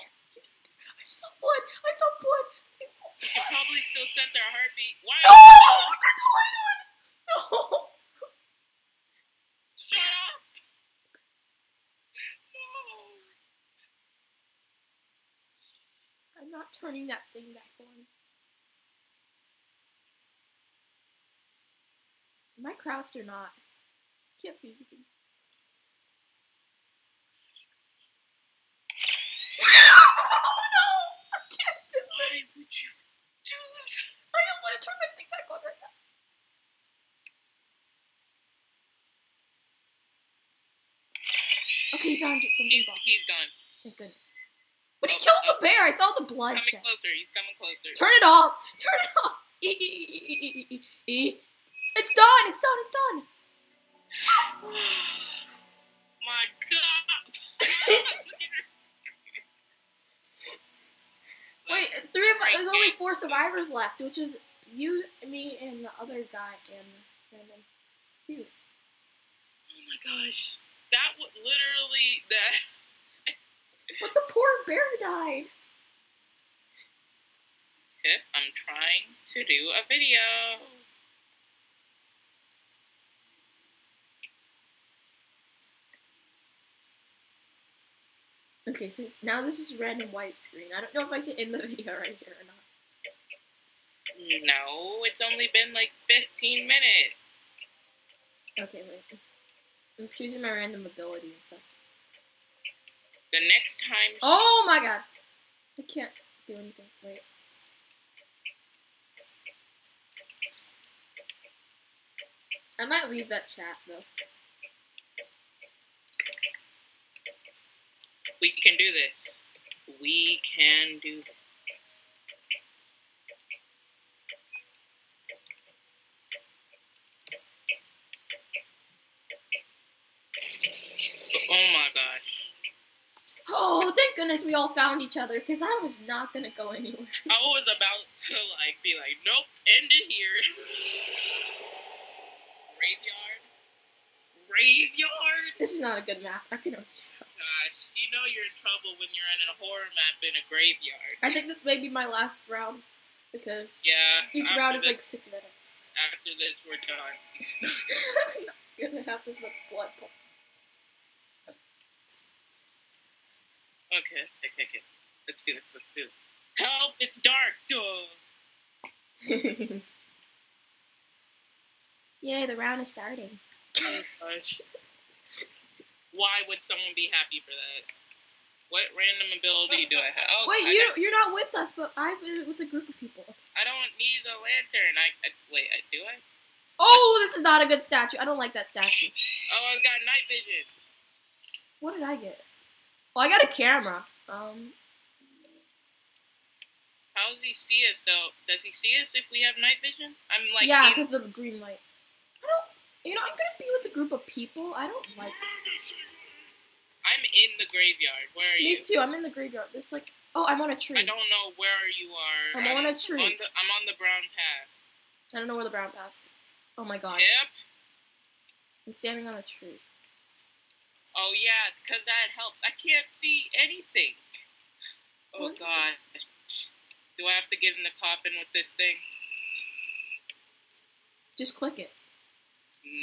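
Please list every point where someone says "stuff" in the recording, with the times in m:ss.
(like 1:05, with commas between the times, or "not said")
1:41.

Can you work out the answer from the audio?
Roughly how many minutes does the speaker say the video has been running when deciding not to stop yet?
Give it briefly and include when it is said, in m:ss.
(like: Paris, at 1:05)
15, at 1:36.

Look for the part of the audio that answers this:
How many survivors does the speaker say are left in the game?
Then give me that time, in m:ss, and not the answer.
1:02.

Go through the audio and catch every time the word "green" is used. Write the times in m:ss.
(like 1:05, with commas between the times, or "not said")
3:21.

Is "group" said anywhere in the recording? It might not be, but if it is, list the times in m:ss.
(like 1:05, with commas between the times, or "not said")
3:02, 3:23.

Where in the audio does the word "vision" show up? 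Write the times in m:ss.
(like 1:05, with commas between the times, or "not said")
3:10, 3:19.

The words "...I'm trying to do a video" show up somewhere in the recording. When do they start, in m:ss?
1:18.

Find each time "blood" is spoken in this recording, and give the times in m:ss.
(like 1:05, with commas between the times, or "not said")
0:46, 2:39.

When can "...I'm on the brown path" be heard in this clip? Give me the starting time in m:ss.
3:33.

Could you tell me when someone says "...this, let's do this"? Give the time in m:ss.
2:45.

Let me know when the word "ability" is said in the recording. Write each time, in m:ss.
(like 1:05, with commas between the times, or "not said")
1:40, 2:59.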